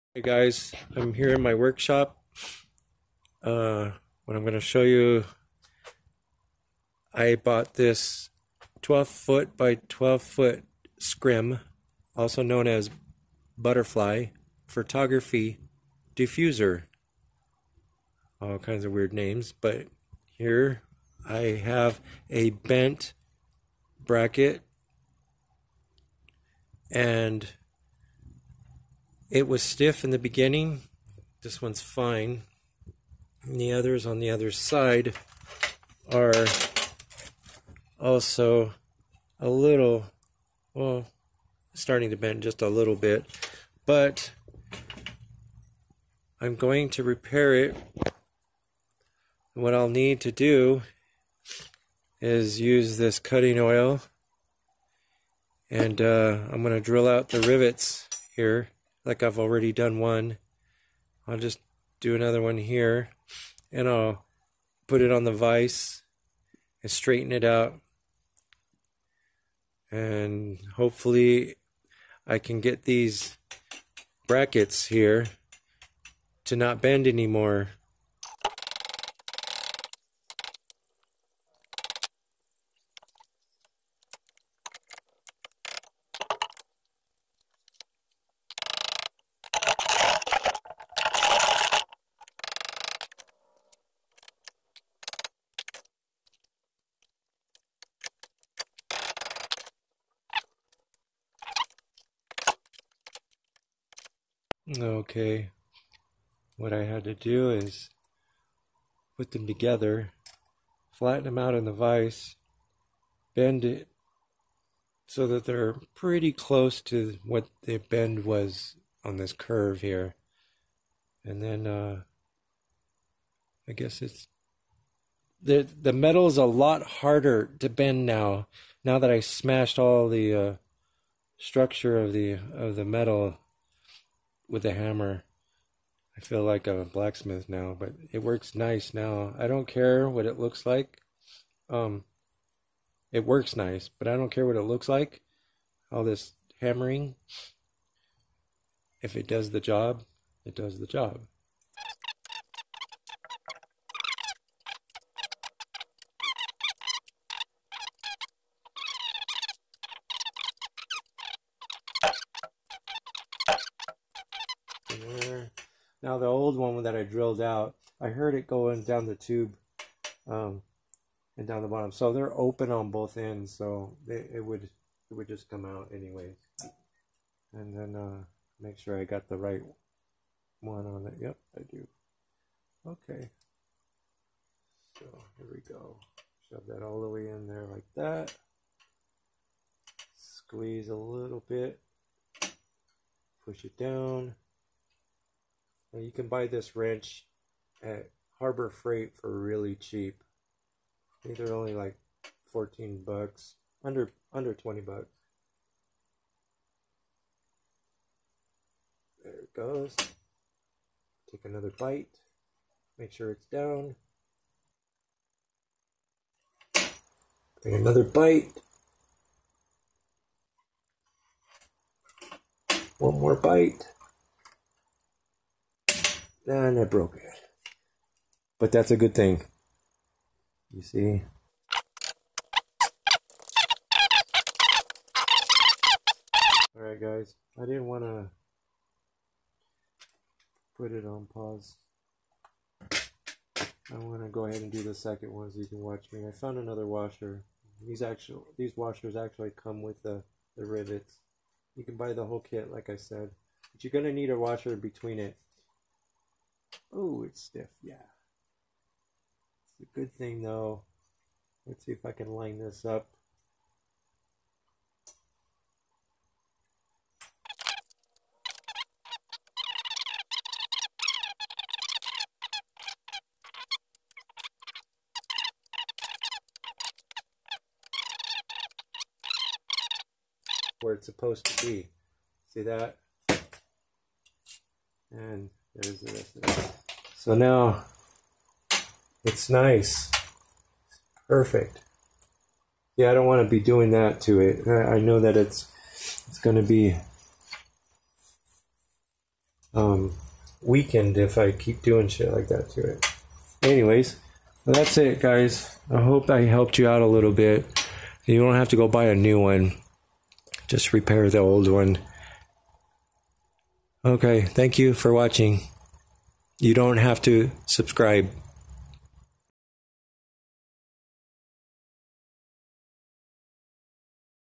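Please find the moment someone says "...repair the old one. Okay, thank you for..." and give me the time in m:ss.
5:10.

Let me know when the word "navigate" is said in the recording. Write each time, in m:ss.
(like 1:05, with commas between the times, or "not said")
not said.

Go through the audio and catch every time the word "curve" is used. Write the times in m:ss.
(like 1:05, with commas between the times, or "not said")
1:59.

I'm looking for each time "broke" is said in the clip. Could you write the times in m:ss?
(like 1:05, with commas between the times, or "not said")
3:46.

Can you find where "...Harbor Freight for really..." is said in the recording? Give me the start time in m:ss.
3:18.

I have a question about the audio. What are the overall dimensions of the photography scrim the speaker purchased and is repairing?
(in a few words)
12 foot by 12 foot.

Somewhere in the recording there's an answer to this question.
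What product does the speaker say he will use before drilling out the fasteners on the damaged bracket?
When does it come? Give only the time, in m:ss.
0:53.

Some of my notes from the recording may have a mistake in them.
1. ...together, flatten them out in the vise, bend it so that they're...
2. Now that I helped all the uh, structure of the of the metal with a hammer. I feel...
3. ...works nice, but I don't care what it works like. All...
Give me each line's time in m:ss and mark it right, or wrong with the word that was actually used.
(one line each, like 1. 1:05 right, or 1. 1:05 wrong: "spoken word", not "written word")
1. 1:49 right
2. 2:08 wrong: "smashed", not "helped"
3. 2:23 wrong: "looks", not "works".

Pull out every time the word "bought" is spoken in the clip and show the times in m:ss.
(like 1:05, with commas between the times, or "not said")
0:07.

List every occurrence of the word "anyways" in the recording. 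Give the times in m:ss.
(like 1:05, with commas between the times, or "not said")
2:55, 5:03.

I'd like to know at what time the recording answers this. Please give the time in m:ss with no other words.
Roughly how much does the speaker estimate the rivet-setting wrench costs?
3:22.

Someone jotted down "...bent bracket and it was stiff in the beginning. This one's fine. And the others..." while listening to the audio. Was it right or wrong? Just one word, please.
right.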